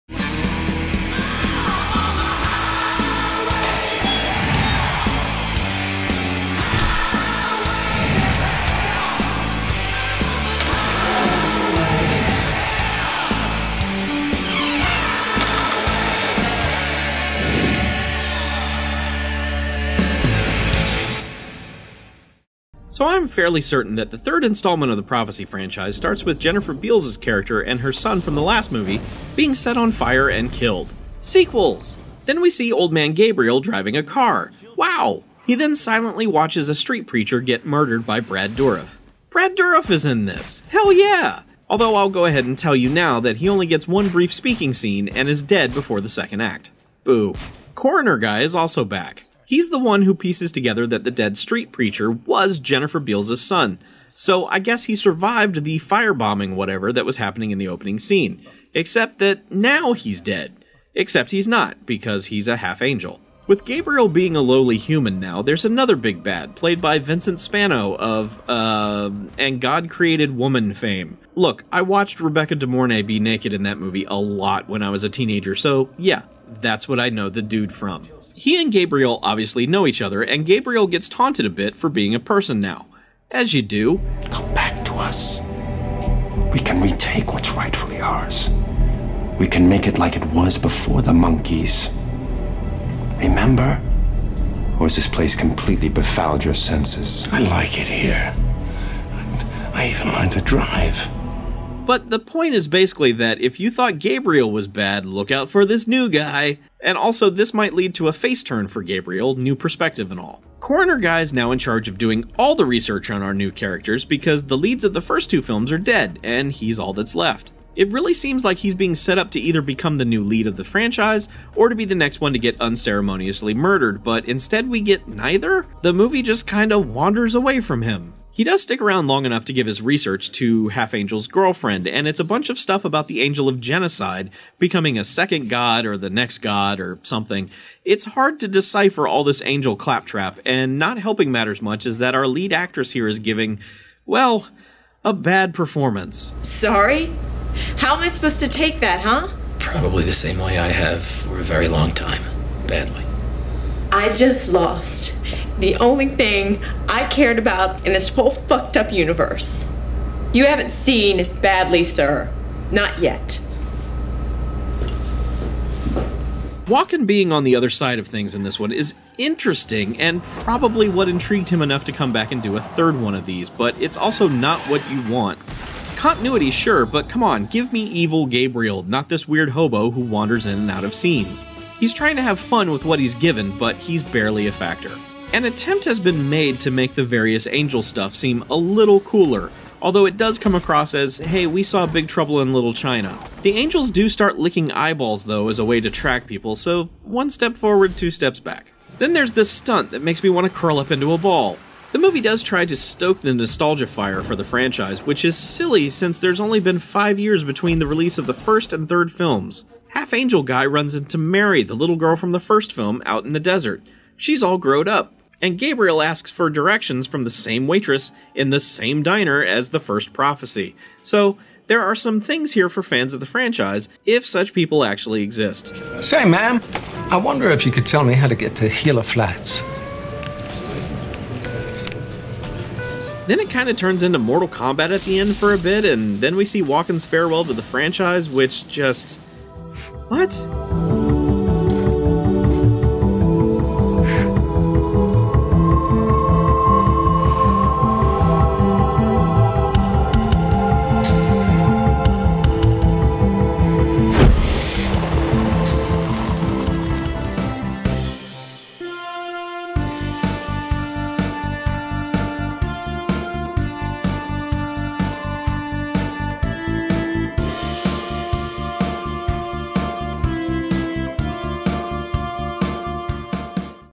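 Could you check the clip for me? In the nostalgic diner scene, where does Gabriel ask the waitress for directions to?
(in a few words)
Gila Flats.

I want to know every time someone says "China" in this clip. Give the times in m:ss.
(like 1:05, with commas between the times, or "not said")
3:12.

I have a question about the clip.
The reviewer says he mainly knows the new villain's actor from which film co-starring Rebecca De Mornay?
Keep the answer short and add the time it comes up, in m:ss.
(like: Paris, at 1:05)
And God Created Woman, at 1:09.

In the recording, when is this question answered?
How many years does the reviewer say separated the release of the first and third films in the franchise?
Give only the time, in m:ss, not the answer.
3:26.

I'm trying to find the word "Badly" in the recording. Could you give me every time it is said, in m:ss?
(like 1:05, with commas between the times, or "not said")
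2:32, 2:41.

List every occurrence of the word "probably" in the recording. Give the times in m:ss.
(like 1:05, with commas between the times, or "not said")
2:29, 2:50.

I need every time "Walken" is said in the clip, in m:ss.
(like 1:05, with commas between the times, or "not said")
2:46, 3:56.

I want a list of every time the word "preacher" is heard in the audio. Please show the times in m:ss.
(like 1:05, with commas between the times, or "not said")
0:37, 0:51.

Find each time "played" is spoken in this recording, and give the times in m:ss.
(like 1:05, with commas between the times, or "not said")
1:06.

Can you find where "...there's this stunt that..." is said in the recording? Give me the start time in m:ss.
3:19.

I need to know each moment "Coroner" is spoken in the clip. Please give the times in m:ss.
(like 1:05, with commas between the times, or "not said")
0:47, 1:50.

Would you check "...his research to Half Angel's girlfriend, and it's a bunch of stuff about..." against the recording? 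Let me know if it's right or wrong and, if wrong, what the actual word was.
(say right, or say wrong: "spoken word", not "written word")
right.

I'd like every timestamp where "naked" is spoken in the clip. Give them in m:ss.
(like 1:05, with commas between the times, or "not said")
1:13.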